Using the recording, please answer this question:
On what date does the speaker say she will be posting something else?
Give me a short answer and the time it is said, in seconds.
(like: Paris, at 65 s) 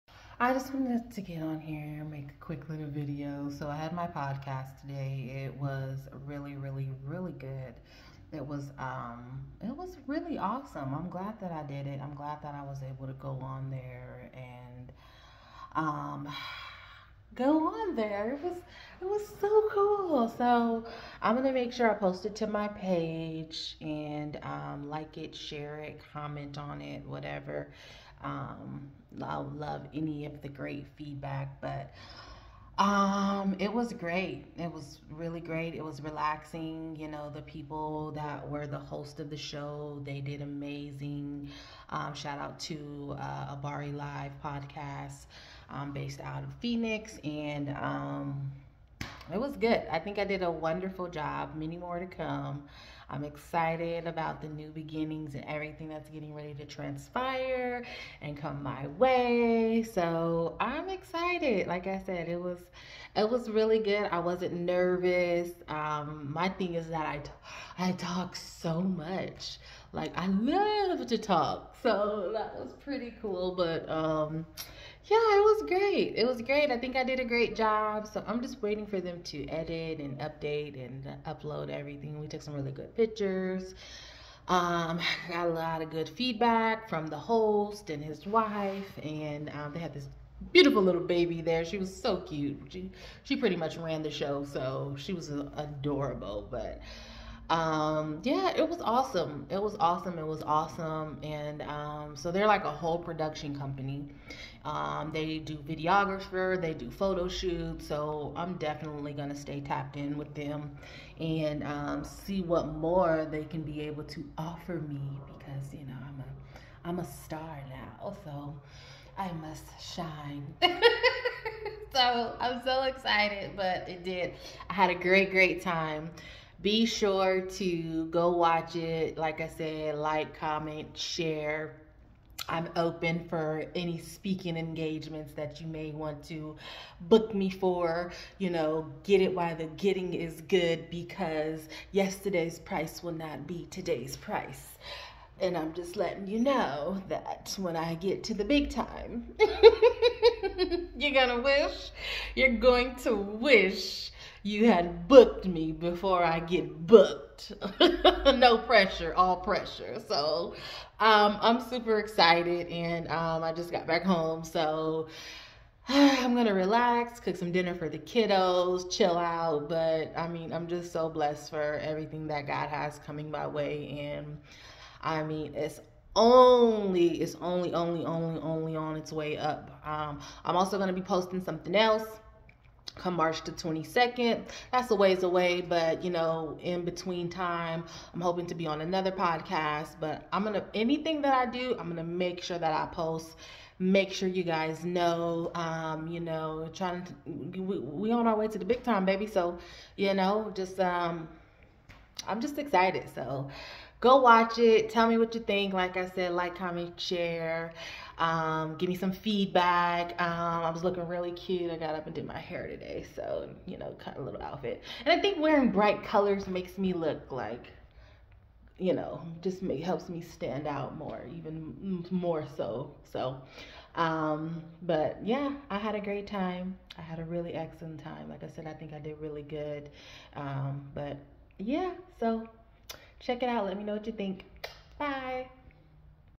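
March 22, at 183 s.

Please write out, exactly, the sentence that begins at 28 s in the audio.
Um, I love any of the great feedback, but um, it was great.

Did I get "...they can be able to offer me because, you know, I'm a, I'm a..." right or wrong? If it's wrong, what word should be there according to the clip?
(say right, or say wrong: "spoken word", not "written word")
right.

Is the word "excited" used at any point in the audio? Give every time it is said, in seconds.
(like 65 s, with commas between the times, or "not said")
53 s, 60 s, 122 s, 161 s, 202 s.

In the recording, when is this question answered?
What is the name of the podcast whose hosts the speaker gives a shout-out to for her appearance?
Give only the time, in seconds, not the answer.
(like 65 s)
43 s.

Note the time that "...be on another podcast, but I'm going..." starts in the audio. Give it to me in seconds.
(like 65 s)
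188 s.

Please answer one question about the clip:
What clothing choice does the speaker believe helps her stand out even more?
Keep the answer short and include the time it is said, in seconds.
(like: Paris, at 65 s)
Bright colors, at 215 s.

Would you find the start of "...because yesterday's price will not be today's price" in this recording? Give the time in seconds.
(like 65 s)
140 s.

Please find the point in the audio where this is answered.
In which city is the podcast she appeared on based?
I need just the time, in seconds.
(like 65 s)
46 s.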